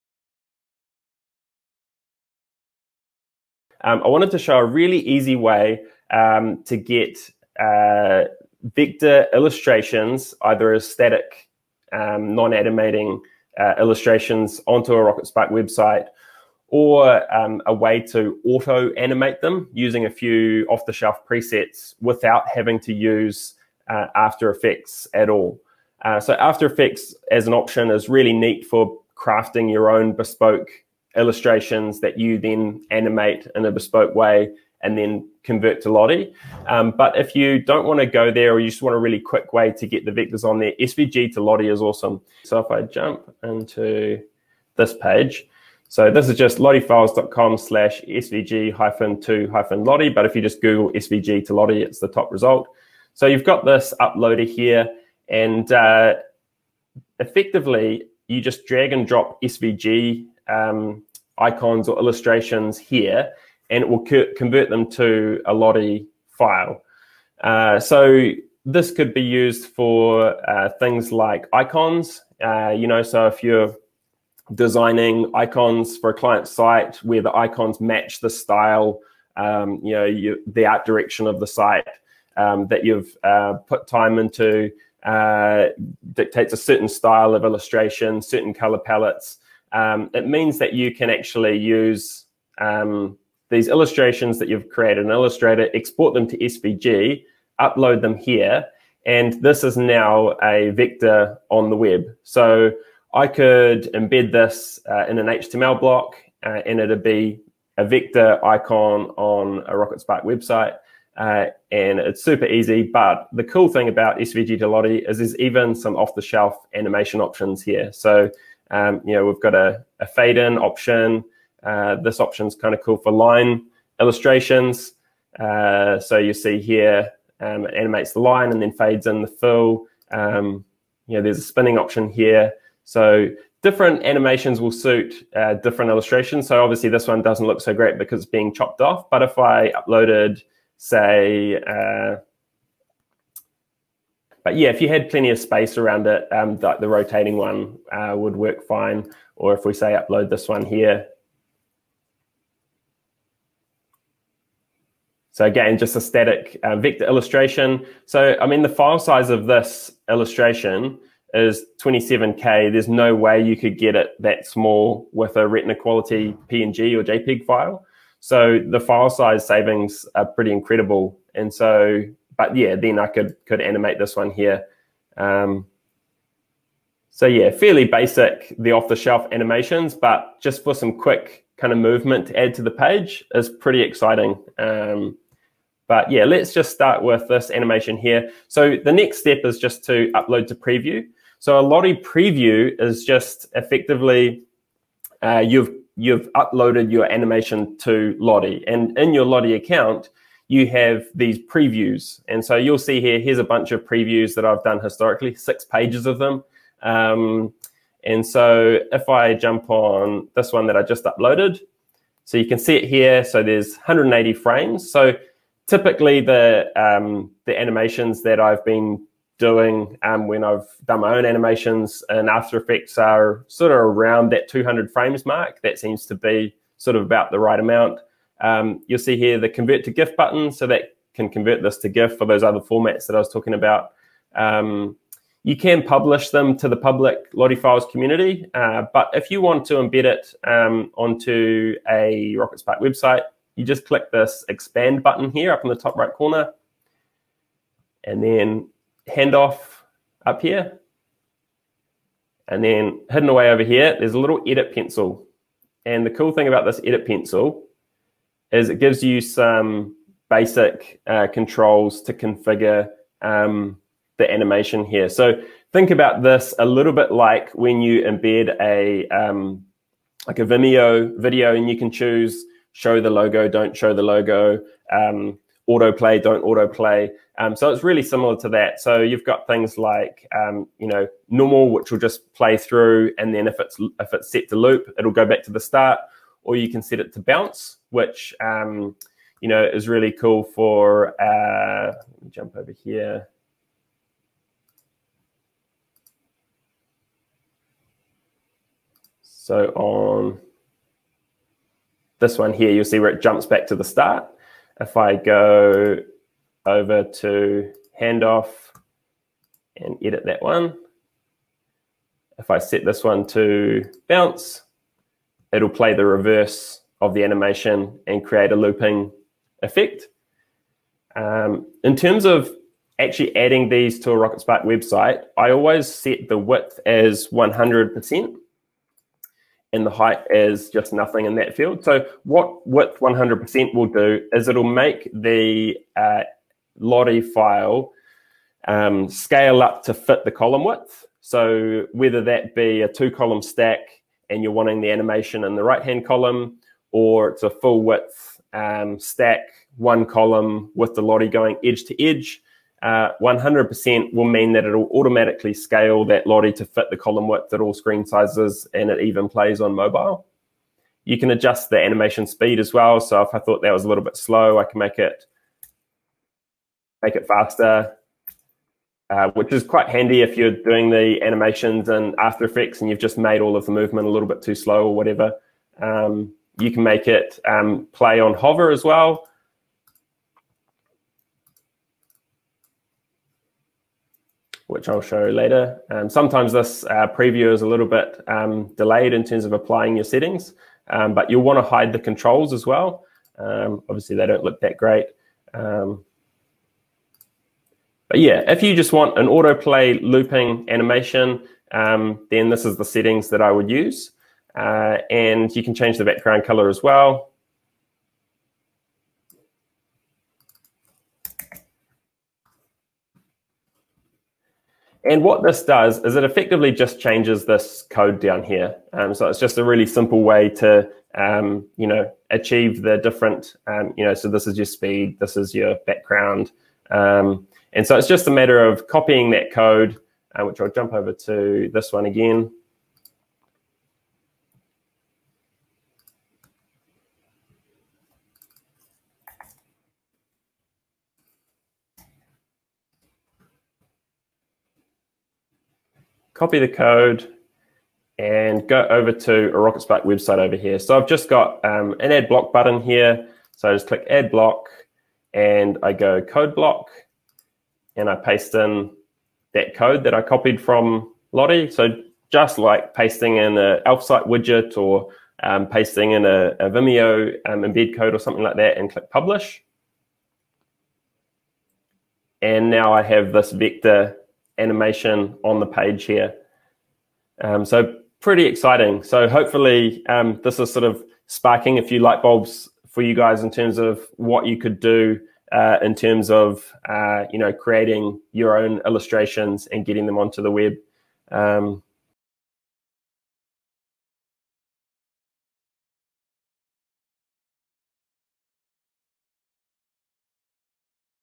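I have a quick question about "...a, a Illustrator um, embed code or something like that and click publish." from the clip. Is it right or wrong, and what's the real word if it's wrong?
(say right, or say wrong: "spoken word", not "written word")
wrong: "Vimeo", not "Illustrator".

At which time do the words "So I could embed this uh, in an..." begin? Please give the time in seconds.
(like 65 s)
102 s.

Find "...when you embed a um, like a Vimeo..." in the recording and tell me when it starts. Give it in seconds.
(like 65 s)
267 s.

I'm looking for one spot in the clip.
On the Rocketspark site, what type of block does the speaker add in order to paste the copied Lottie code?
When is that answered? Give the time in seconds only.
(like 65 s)
456 s.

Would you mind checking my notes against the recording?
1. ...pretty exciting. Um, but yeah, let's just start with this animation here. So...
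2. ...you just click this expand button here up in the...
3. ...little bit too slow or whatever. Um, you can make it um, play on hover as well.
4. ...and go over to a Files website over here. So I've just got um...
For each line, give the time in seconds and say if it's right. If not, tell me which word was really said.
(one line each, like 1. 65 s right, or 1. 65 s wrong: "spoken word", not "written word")
1. 183 s right
2. 243 s right
3. 374 s right
4. 448 s wrong: "Rocketspark", not "Files".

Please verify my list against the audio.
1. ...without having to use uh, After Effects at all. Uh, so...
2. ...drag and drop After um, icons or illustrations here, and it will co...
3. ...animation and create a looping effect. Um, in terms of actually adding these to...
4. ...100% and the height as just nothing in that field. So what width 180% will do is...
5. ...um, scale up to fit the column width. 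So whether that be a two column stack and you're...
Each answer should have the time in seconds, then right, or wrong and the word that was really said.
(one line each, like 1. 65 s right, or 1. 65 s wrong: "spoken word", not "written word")
1. 22 s right
2. 58 s wrong: "SVG", not "After"
3. 317 s right
4. 327 s wrong: "100", not "180"
5. 338 s right.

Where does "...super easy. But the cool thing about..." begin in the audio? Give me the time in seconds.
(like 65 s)
112 s.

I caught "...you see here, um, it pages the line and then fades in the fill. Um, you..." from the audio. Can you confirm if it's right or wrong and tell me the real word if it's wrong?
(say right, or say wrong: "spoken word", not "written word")
wrong: "animates", not "pages".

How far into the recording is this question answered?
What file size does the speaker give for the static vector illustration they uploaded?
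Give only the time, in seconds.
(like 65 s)
161 s.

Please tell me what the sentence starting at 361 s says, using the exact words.
You can adjust the animation speed as well.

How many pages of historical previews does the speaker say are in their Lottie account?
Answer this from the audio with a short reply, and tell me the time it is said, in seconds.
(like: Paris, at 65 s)
6, at 205 s.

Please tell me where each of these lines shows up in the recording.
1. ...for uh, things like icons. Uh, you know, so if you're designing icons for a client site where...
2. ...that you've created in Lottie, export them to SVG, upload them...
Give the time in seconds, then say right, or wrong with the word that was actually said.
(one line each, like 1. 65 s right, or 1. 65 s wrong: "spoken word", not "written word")
1. 69 s right
2. 94 s wrong: "Illustrator", not "Lottie".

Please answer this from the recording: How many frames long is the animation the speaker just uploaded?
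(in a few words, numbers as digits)
180.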